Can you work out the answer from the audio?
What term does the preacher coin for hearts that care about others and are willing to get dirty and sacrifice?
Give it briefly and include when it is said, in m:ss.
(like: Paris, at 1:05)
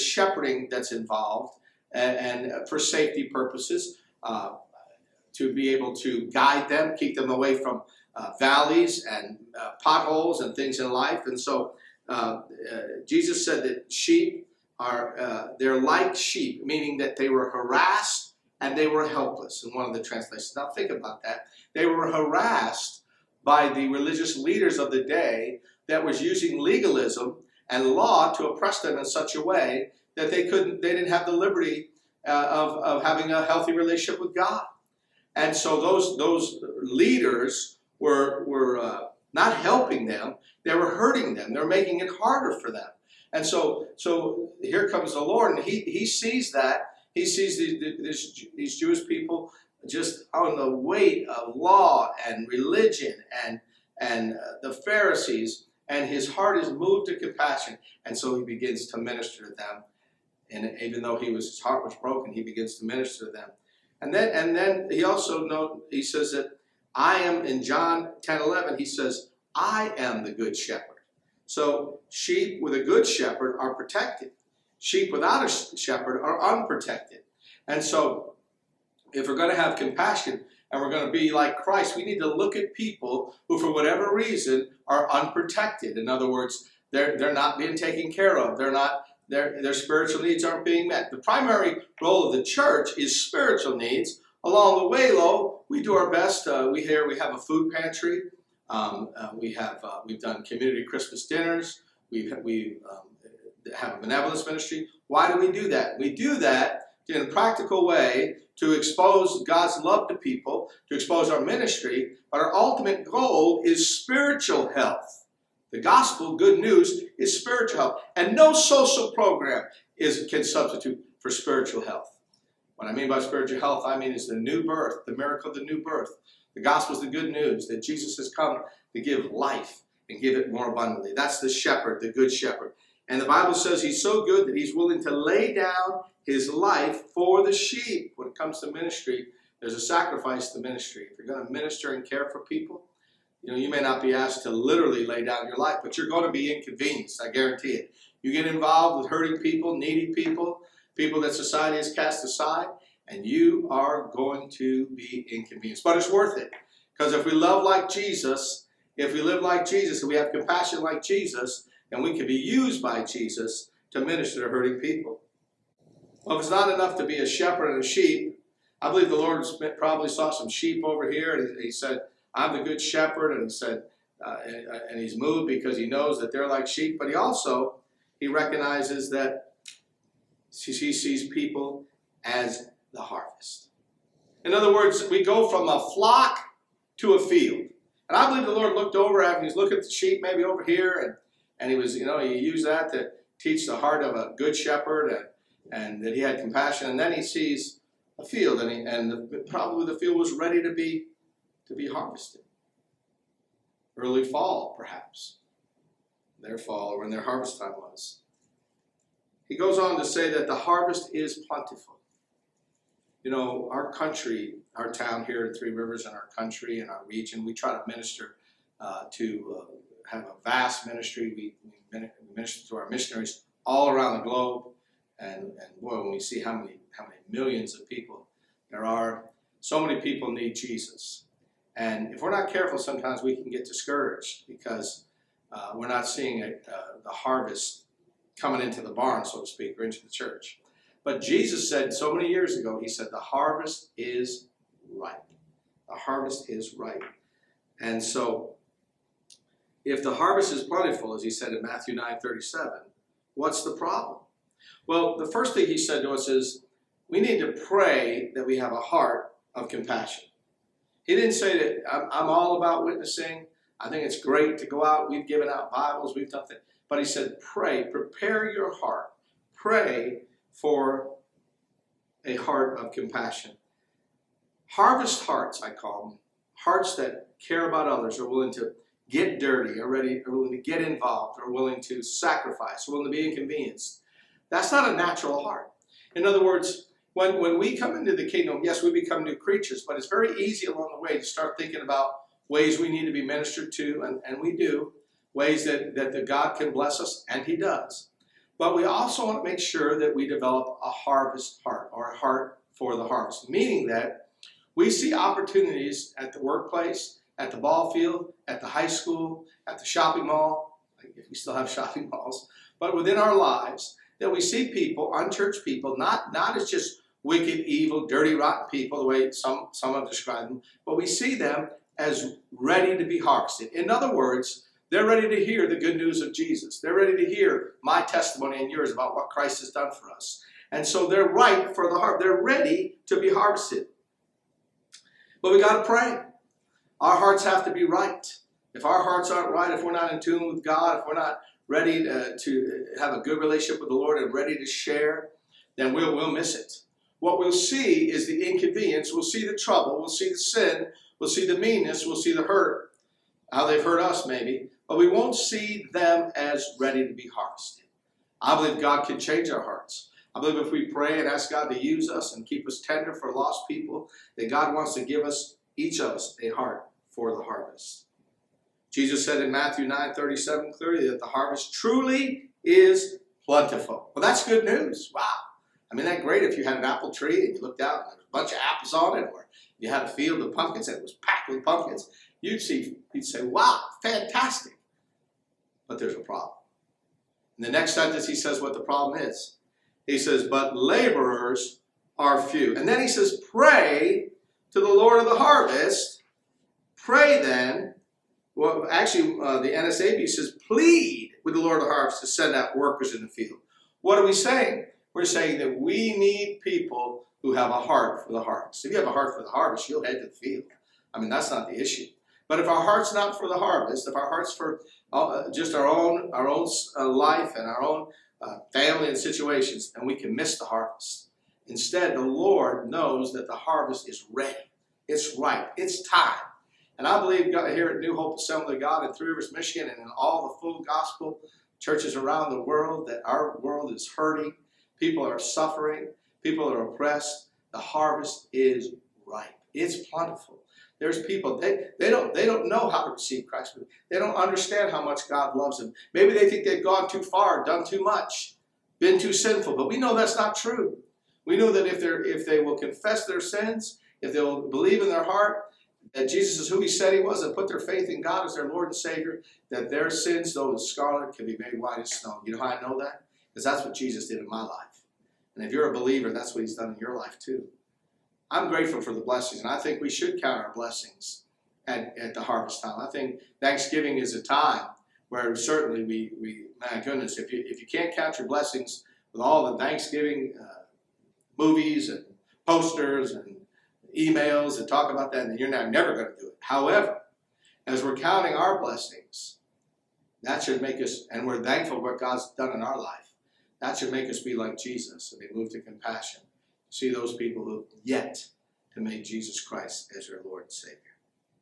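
Harvest hearts, at 4:34.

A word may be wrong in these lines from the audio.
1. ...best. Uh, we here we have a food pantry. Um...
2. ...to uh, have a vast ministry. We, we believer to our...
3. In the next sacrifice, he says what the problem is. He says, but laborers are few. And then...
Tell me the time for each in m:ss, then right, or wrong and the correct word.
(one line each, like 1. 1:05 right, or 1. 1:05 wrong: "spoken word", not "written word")
1. 1:36 right
2. 3:39 wrong: "minister", not "believer"
3. 6:27 wrong: "sentence", not "sacrifice".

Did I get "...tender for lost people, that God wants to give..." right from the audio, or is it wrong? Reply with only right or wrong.
right.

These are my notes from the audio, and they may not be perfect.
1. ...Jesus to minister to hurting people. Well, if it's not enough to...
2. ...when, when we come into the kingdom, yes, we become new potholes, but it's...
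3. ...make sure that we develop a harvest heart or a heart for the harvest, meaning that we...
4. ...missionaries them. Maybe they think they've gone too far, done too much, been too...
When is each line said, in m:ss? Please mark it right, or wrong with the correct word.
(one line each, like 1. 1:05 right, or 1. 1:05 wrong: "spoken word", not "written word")
1. 2:43 right
2. 4:47 wrong: "creatures", not "potholes"
3. 4:59 right
4. 7:25 wrong: "loves", not "missionaries".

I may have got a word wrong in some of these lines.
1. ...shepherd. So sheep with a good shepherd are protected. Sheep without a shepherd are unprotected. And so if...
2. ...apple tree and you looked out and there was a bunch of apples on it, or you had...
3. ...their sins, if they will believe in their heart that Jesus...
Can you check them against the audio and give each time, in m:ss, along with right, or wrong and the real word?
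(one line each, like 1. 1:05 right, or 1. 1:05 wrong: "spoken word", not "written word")
1. 1:10 right
2. 6:16 right
3. 7:33 right.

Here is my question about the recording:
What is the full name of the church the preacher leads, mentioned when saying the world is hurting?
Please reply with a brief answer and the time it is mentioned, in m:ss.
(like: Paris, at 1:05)
New Hope Assembly of God, at 7:07.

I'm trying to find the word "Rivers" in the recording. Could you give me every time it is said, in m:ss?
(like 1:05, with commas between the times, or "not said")
3:35, 7:09.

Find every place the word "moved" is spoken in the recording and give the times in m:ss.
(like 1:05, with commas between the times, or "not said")
0:56, 2:55, 8:15.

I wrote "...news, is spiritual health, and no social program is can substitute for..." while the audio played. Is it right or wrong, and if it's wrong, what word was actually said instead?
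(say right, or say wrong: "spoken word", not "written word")
right.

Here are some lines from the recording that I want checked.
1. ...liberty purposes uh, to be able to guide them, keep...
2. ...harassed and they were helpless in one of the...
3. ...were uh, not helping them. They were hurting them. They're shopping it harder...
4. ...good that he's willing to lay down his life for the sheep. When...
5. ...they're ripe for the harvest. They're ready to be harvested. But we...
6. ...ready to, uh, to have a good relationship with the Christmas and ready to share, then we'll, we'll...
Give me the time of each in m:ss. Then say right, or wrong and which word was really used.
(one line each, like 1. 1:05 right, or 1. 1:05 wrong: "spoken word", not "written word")
1. 0:02 wrong: "safety", not "liberty"
2. 0:17 right
3. 0:38 wrong: "making", not "shopping"
4. 2:14 right
5. 5:31 right
6. 5:41 wrong: "Lord", not "Christmas".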